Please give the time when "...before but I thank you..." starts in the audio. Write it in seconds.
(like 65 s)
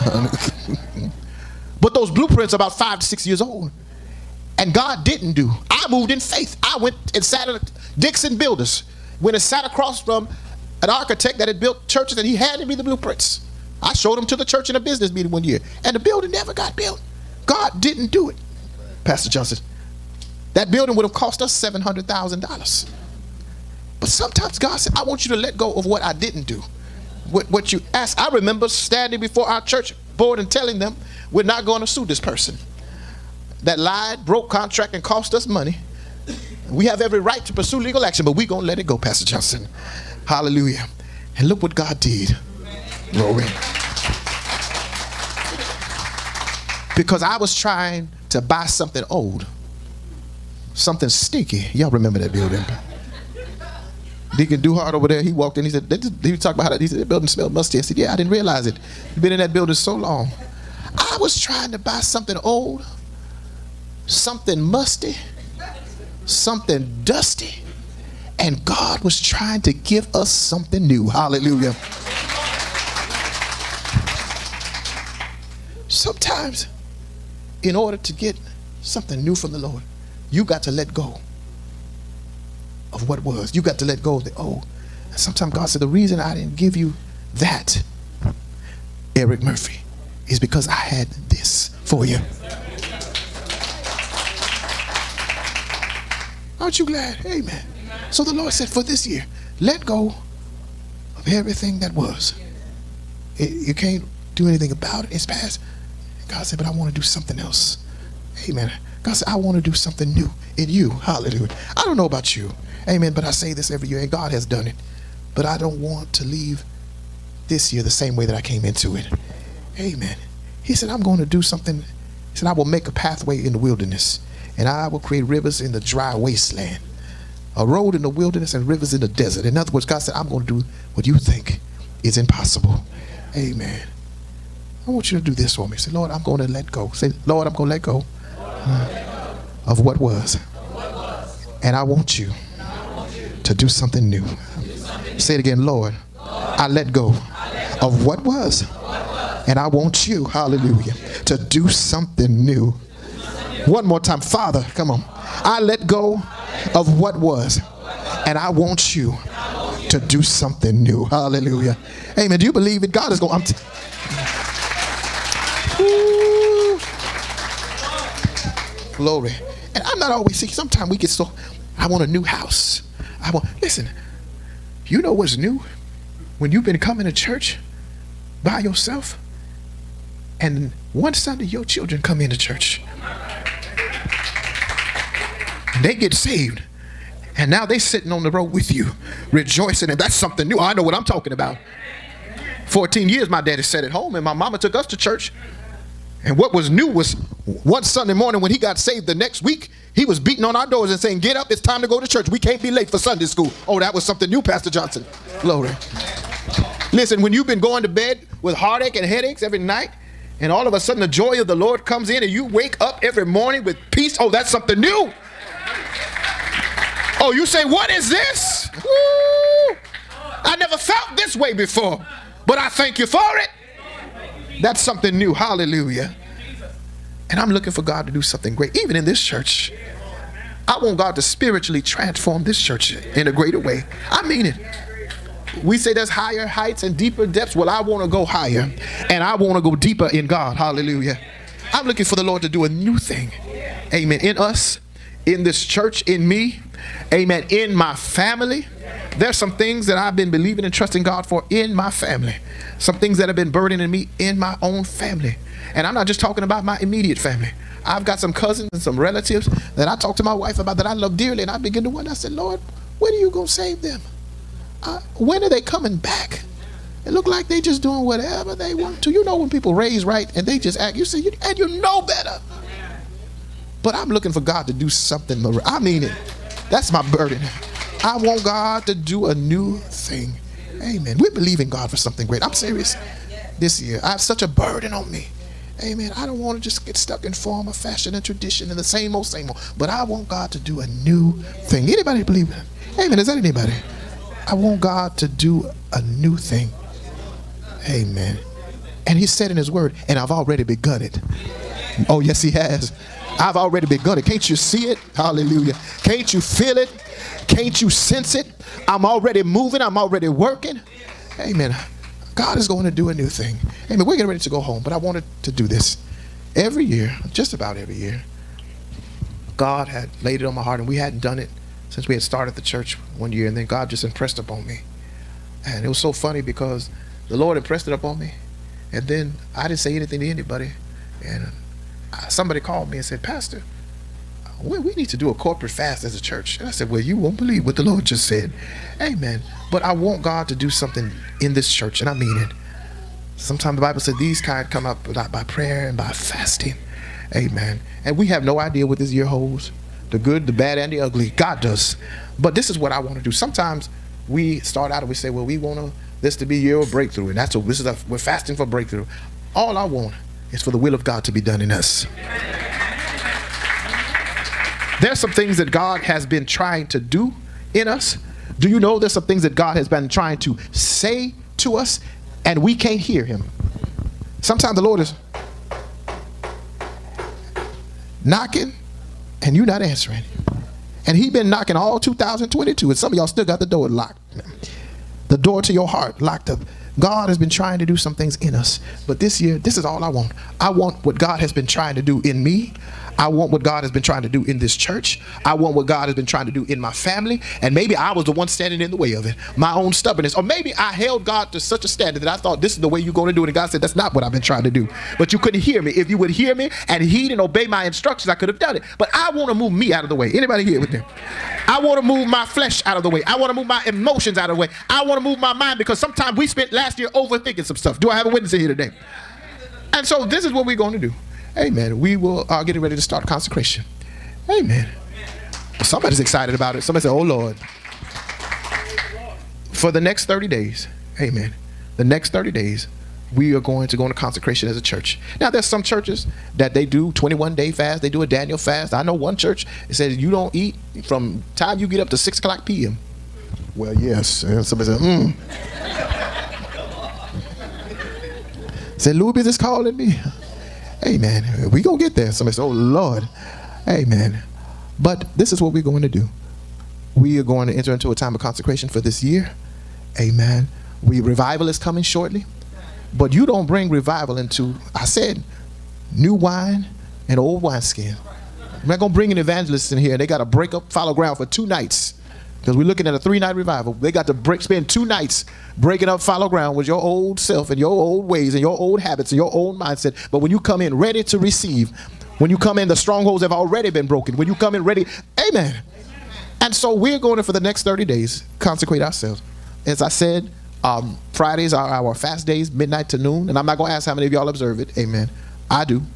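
221 s.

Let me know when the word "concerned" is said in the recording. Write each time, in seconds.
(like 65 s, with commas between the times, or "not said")
not said.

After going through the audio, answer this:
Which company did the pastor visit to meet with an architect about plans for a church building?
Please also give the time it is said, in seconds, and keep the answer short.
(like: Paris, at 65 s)
Dixon Builders, at 7 s.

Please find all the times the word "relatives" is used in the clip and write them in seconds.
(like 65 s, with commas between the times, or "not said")
258 s.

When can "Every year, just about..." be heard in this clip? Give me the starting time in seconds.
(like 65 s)
316 s.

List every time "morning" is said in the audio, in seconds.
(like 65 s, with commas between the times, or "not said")
198 s, 213 s.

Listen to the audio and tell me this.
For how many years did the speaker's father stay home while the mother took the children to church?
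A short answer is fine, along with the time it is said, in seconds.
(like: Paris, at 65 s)
14, at 192 s.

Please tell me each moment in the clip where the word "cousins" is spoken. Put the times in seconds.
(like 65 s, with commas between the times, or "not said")
258 s.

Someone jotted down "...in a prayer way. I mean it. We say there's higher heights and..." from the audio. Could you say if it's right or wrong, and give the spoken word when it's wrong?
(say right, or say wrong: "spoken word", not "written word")
wrong: "greater", not "prayer".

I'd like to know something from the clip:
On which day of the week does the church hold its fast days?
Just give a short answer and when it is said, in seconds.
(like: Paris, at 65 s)
Fridays, at 491 s.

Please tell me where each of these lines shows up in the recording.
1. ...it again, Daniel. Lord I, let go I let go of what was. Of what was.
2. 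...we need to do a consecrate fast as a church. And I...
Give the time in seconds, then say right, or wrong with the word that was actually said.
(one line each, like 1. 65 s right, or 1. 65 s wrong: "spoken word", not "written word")
1. 145 s wrong: "Lord", not "Daniel"
2. 334 s wrong: "corporate", not "consecrate".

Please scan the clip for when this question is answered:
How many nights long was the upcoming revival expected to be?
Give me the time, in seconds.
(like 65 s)
473 s.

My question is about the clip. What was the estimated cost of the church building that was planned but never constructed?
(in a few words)
$700,000.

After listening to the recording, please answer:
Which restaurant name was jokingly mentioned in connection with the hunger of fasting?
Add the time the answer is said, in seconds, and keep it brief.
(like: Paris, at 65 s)
Luby's, at 449 s.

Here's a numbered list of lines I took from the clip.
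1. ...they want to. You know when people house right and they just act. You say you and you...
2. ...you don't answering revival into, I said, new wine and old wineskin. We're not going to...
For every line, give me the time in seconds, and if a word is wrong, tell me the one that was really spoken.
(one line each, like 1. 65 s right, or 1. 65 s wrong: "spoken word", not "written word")
1. 268 s wrong: "raise", not "house"
2. 463 s wrong: "bring", not "answering".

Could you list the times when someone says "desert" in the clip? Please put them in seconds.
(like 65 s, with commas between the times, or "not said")
129 s.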